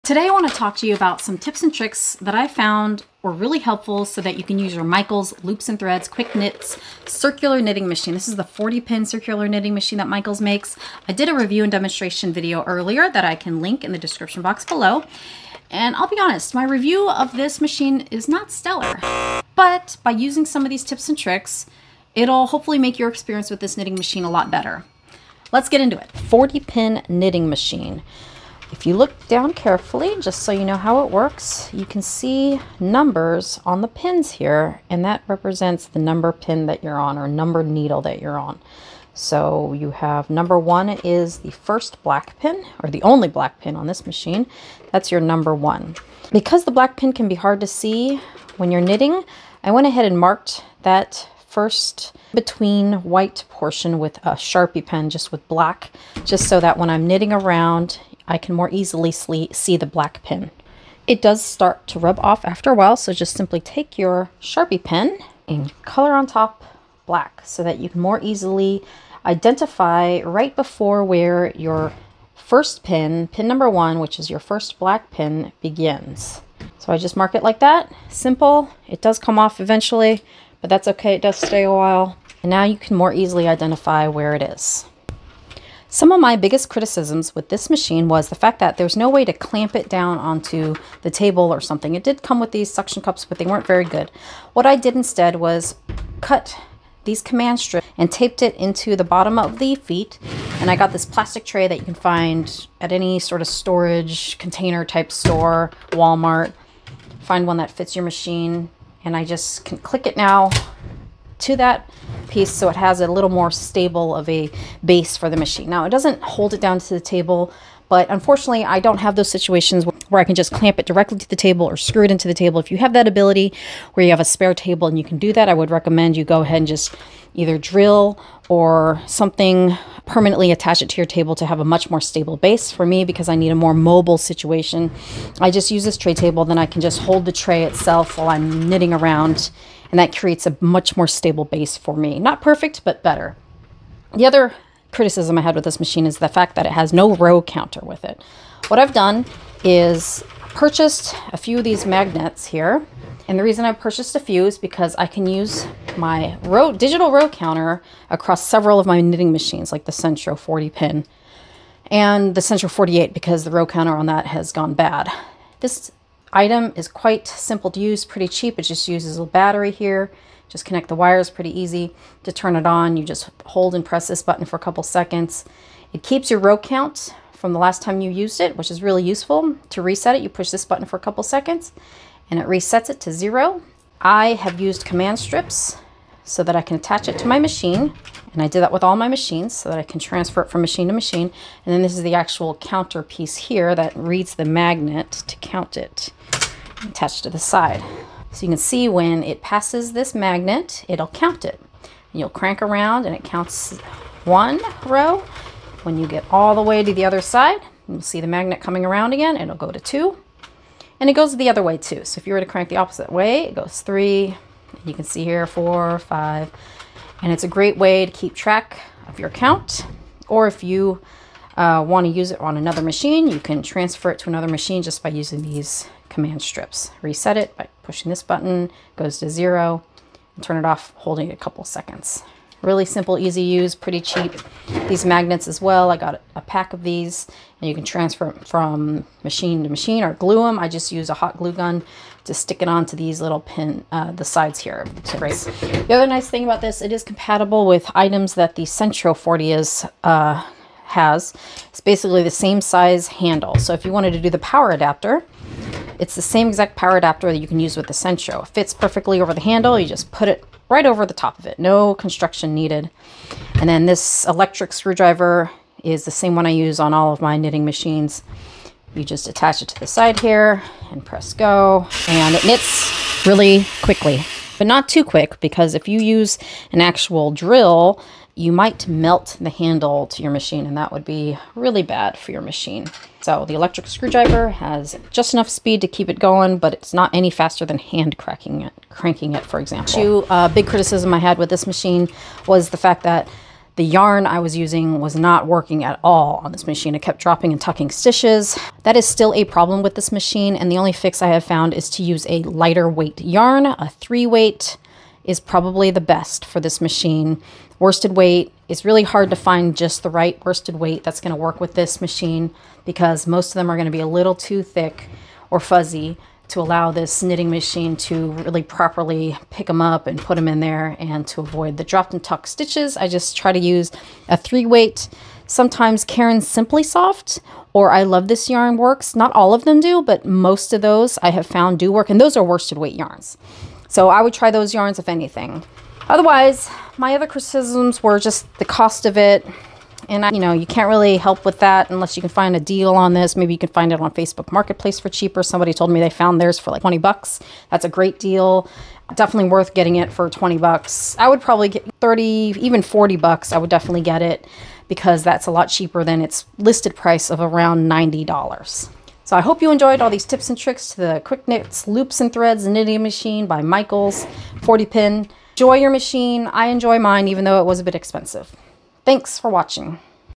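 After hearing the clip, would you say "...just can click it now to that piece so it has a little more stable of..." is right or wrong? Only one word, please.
right.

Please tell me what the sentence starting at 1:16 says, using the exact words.
So I just mark it like that, simple.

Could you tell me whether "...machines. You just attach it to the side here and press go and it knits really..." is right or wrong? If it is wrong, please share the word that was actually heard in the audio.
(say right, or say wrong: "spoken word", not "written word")
right.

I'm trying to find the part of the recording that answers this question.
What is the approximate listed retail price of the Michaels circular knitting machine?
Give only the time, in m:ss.
5:57.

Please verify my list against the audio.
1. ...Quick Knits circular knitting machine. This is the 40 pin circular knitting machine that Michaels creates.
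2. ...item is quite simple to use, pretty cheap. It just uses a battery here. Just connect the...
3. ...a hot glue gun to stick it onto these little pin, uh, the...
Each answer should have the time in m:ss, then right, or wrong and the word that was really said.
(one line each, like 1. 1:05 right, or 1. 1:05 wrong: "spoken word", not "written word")
1. 0:06 wrong: "makes", not "creates"
2. 2:46 right
3. 4:01 right.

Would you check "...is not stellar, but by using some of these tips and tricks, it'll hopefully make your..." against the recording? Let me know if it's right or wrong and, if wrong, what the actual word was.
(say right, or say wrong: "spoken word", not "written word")
right.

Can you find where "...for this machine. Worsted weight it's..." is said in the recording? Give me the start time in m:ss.
5:06.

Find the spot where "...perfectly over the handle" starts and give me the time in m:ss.
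4:18.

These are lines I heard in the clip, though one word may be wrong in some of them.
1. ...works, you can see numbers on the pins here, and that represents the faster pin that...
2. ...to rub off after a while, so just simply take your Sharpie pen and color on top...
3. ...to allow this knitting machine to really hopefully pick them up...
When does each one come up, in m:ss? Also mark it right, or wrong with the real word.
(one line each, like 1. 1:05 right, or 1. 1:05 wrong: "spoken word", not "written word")
1. 0:31 wrong: "number", not "faster"
2. 1:01 right
3. 5:16 wrong: "properly", not "hopefully".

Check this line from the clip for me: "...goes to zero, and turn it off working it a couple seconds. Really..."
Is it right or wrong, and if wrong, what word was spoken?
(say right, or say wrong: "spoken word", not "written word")
wrong: "holding", not "working".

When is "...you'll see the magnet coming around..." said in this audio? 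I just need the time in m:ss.
3:27.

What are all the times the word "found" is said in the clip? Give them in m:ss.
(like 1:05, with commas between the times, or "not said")
0:02, 5:01, 5:31, 5:46.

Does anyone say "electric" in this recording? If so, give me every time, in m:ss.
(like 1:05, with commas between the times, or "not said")
4:24, 4:43.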